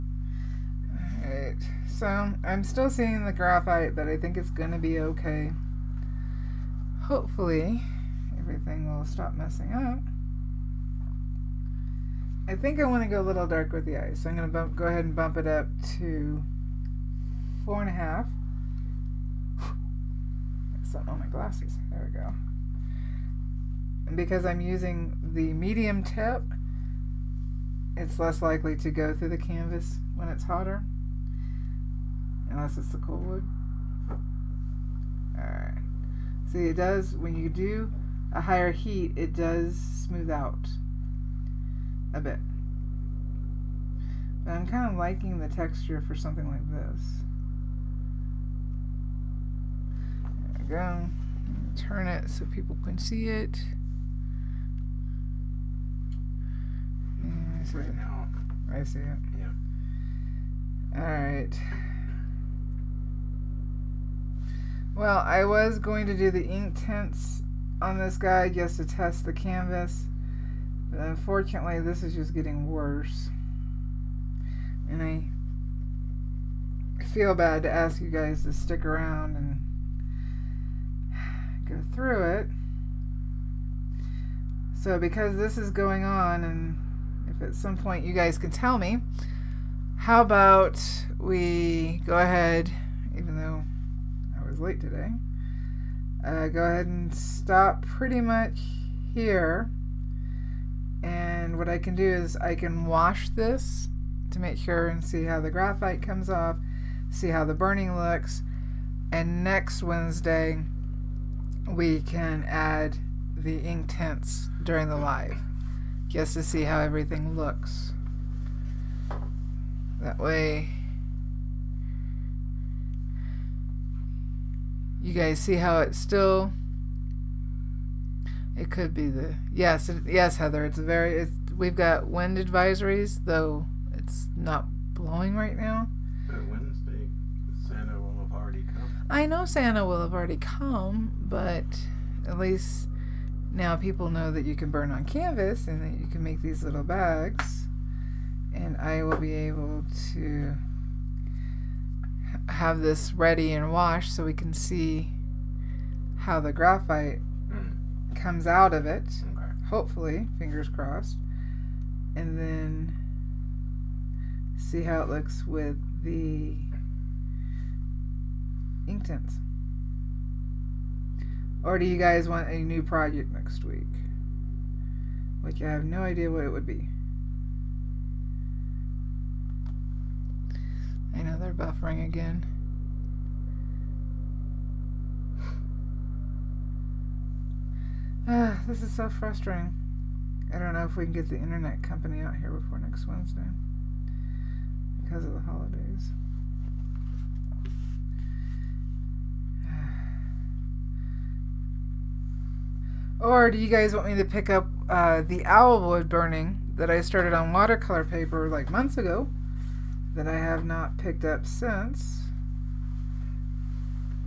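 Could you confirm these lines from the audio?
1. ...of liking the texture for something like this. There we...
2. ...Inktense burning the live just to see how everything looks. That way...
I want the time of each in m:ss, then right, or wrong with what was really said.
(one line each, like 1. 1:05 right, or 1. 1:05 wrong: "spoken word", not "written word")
1. 0:44 right
2. 1:53 wrong: "during", not "burning".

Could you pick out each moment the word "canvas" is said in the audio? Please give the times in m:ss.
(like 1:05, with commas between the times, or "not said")
0:29, 1:09, 2:25.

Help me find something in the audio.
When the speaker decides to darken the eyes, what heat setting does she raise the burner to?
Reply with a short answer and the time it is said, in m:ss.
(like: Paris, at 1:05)
4.5, at 0:17.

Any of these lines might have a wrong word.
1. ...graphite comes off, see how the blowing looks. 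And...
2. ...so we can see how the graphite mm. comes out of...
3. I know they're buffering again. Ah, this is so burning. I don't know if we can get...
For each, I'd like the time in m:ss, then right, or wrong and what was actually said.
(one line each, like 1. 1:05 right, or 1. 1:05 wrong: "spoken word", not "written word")
1. 1:45 wrong: "burning", not "blowing"
2. 2:34 right
3. 3:01 wrong: "frustrating", not "burning".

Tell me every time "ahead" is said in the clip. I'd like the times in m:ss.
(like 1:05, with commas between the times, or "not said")
0:14, 1:32, 1:36.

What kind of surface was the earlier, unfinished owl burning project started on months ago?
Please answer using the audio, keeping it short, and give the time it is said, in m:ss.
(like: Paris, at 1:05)
watercolor paper, at 3:27.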